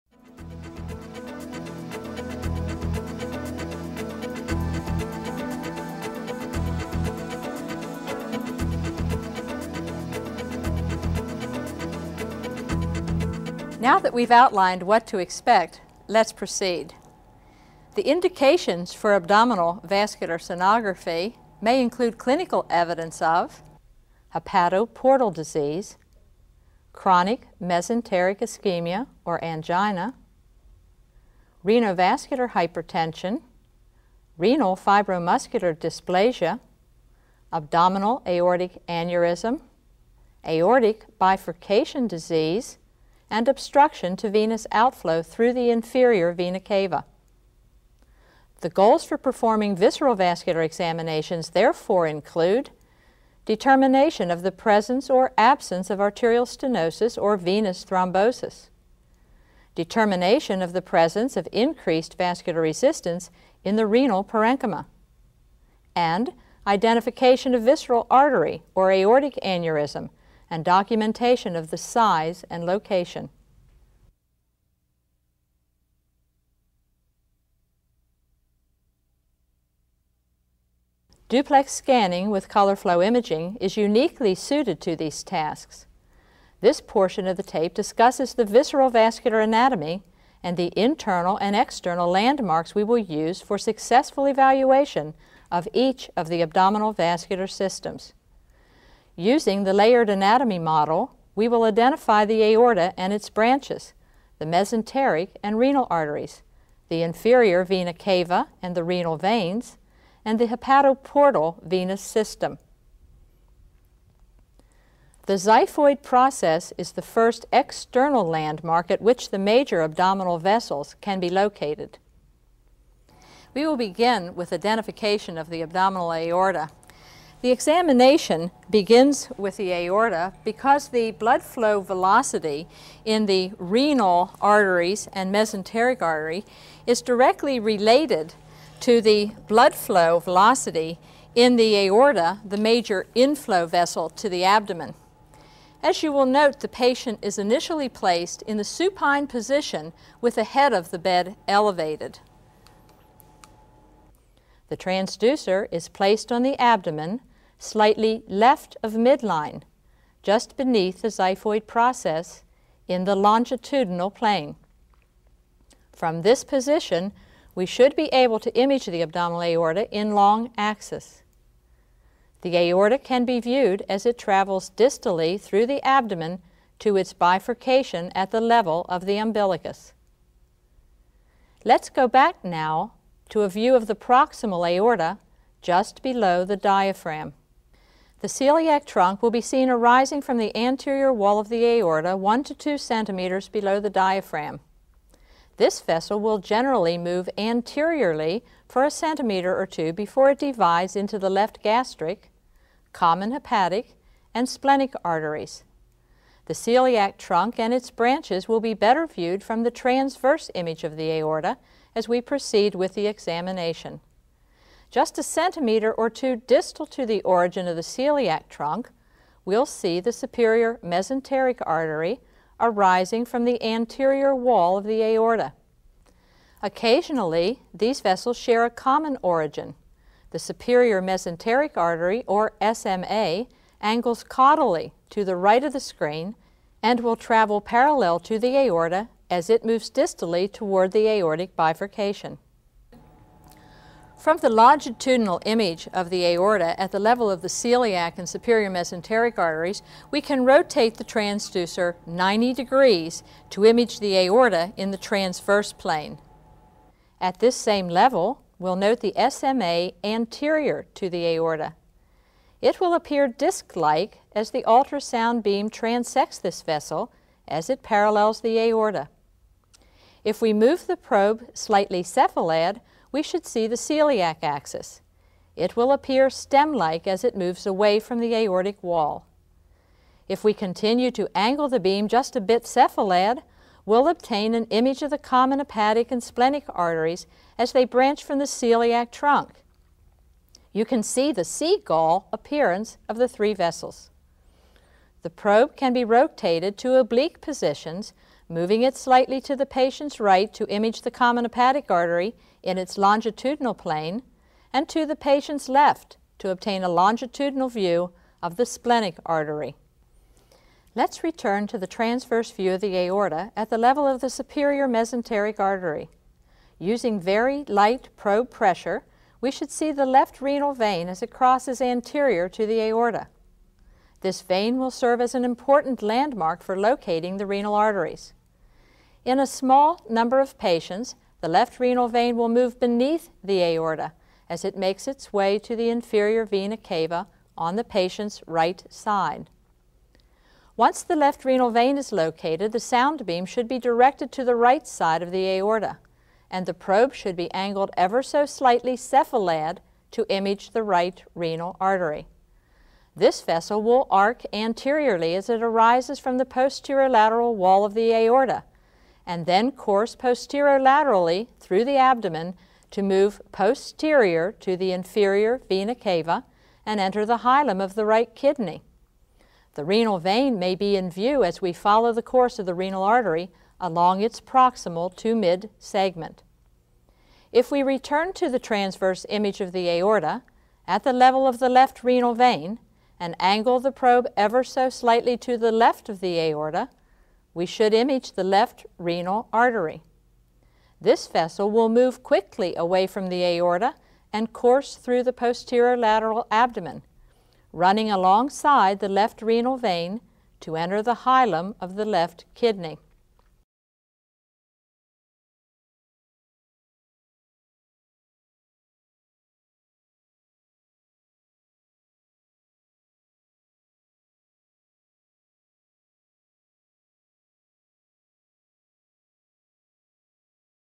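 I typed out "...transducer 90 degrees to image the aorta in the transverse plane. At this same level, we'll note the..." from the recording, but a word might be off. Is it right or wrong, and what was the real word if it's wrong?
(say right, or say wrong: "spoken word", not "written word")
right.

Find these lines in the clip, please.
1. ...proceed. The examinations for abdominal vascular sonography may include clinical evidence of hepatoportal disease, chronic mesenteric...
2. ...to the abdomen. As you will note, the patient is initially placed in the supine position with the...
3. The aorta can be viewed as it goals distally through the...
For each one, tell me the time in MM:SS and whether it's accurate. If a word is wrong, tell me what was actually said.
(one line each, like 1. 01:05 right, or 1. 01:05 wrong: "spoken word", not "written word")
1. 00:16 wrong: "indications", not "examinations"
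2. 02:24 right
3. 02:52 wrong: "travels", not "goals".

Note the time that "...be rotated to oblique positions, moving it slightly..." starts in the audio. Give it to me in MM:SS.
04:55.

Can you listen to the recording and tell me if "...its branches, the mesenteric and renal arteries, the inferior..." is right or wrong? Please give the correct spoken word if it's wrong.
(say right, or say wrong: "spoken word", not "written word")
right.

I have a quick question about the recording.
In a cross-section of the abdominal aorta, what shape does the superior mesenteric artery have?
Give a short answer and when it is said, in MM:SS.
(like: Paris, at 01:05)
disc-like, at 04:23.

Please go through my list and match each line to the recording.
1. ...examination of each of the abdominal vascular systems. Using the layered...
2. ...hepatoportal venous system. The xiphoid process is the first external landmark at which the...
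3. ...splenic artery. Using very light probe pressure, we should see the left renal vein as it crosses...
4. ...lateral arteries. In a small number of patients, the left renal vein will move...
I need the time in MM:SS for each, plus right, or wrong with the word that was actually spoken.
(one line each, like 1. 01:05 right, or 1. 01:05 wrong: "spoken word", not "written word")
1. 01:34 wrong: "evaluation", not "examination"
2. 01:50 right
3. 05:14 wrong: "mesenteric", not "splenic"
4. 05:27 wrong: "renal", not "lateral".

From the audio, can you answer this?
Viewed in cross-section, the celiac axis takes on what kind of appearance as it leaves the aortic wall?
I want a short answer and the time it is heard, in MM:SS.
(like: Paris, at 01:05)
stem-like, at 04:36.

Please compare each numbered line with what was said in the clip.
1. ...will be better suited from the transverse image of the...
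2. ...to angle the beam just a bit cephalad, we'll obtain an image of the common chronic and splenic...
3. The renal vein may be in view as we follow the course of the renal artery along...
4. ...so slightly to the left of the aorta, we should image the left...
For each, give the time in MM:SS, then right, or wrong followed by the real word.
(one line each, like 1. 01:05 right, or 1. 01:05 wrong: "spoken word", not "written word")
1. 03:28 wrong: "viewed", not "suited"
2. 04:41 wrong: "hepatic", not "chronic"
3. 06:09 right
4. 06:24 right.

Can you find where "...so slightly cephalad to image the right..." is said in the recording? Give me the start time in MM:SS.
05:48.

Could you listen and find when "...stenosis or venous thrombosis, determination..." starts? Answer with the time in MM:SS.
00:56.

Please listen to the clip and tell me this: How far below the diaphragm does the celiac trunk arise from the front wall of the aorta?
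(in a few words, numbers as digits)
1 to 2 centimeters.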